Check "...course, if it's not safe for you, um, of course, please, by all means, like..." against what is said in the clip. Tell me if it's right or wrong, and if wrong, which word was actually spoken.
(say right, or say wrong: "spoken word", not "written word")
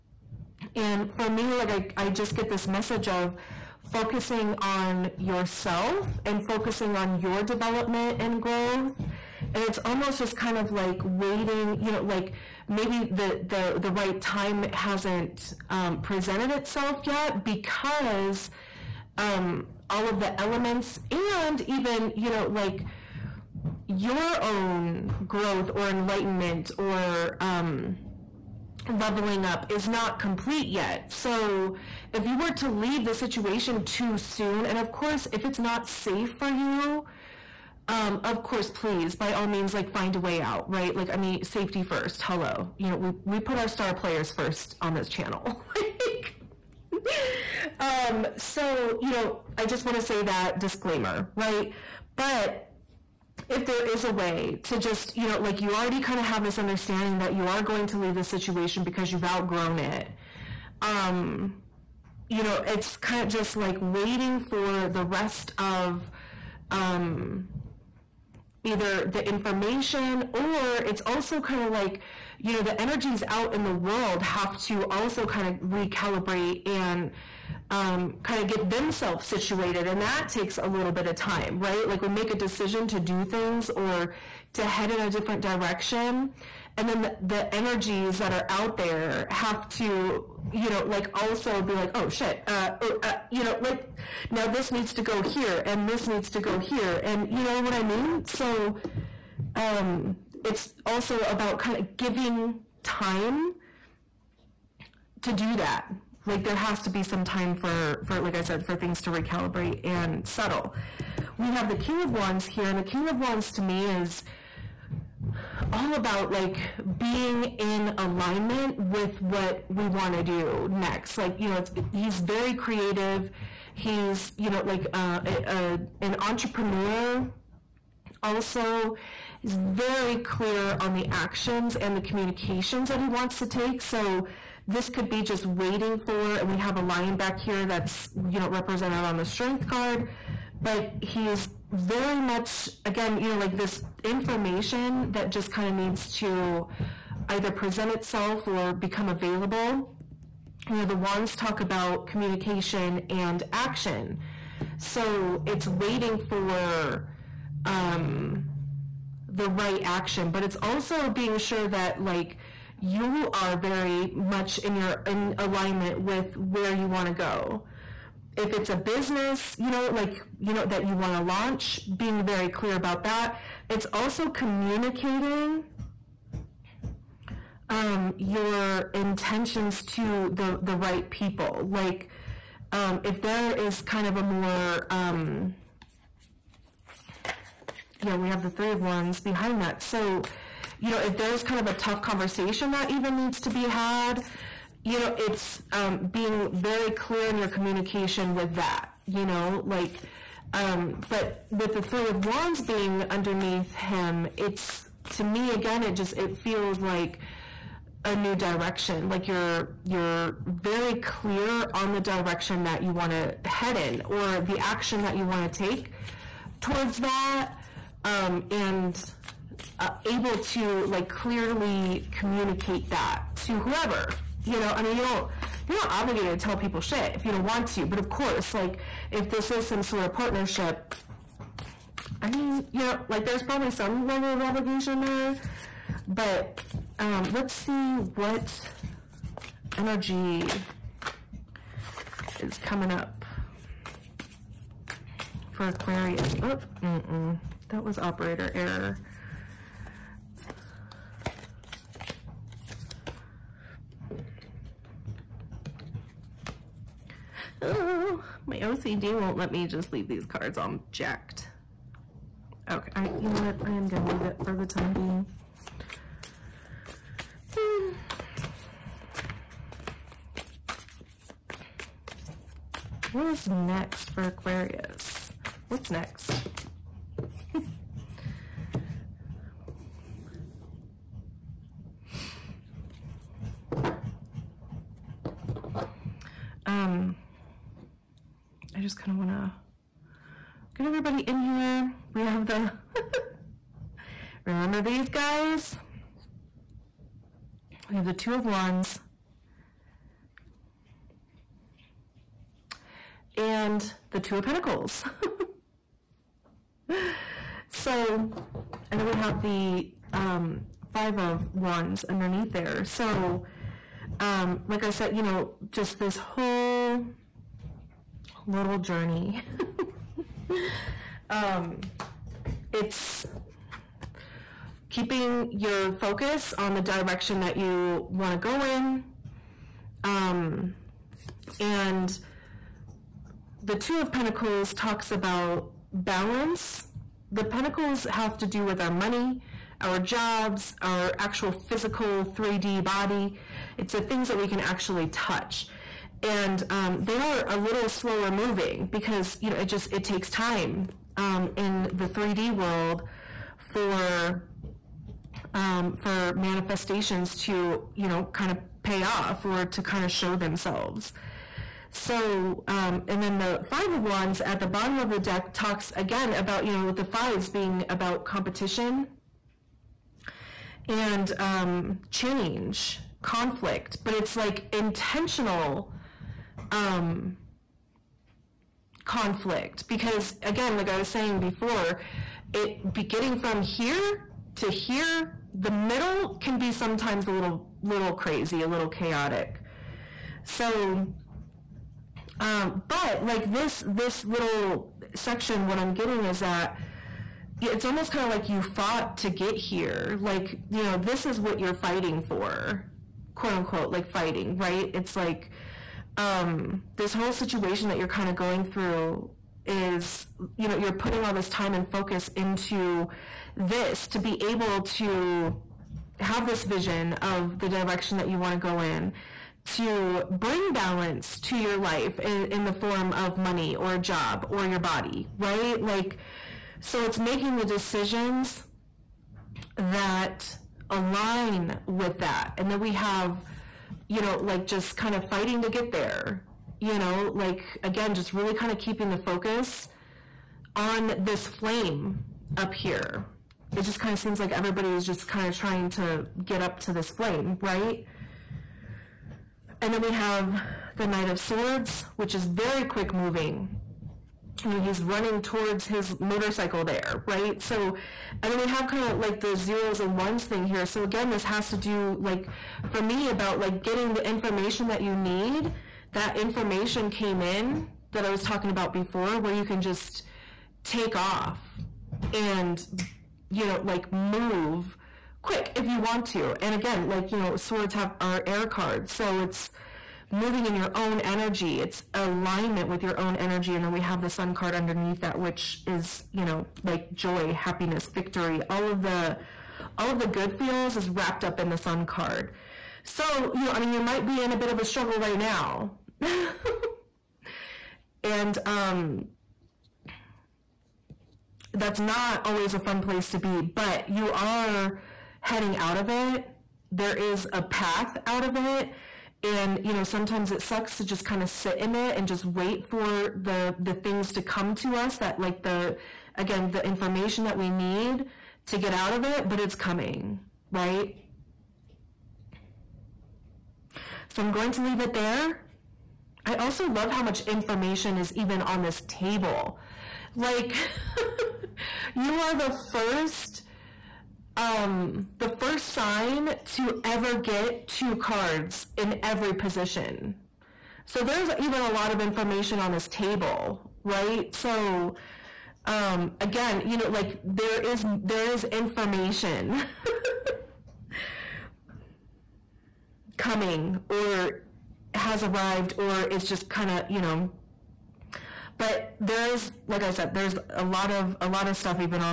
right.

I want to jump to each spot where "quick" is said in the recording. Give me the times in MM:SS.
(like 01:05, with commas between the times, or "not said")
07:32, 07:55.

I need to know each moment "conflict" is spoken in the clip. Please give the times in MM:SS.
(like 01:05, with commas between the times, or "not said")
06:13, 06:19.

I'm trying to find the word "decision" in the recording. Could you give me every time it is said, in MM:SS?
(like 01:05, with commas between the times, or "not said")
01:22, 07:07.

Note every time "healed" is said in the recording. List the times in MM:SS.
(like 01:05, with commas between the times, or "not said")
not said.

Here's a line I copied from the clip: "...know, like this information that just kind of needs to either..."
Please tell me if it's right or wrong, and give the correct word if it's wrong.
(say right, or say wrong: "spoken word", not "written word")
right.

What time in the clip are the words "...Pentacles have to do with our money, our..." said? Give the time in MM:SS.
05:37.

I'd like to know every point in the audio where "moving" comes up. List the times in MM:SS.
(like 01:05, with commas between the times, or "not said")
05:48, 07:33, 08:00.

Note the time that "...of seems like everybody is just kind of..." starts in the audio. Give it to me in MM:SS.
07:24.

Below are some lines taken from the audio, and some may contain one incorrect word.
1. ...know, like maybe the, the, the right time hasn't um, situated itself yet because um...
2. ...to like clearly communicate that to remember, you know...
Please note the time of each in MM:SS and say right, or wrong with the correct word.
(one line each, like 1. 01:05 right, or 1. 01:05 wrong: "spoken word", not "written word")
1. 00:11 wrong: "presented", not "situated"
2. 03:40 wrong: "whoever", not "remember".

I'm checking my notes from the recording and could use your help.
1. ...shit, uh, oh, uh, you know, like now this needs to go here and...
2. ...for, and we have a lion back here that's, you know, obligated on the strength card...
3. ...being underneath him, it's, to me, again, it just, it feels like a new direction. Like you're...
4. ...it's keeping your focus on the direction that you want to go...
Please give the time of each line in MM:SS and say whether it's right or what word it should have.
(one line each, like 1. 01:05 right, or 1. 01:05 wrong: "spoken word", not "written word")
1. 01:32 right
2. 02:15 wrong: "represented", not "obligated"
3. 03:22 right
4. 05:22 right.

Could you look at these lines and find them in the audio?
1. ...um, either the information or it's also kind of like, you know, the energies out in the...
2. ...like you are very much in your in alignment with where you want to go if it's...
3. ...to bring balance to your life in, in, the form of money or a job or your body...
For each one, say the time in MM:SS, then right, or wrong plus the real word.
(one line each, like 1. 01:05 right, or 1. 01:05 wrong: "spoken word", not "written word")
1. 01:06 right
2. 02:42 right
3. 06:59 right.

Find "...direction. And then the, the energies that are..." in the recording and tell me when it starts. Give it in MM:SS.
01:25.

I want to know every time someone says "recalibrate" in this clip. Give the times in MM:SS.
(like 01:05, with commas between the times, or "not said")
01:15, 01:49.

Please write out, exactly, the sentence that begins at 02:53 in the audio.
It's also communicating um, your intentions to the, the right people.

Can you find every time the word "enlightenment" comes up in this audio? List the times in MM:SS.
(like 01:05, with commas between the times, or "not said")
00:25.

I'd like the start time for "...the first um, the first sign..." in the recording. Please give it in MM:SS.
08:52.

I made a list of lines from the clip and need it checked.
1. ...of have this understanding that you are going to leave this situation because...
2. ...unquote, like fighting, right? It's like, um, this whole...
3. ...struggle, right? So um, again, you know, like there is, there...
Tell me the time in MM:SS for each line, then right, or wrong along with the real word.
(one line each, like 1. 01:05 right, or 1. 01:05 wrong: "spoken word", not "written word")
1. 00:56 right
2. 06:43 right
3. 09:03 wrong: "table", not "struggle".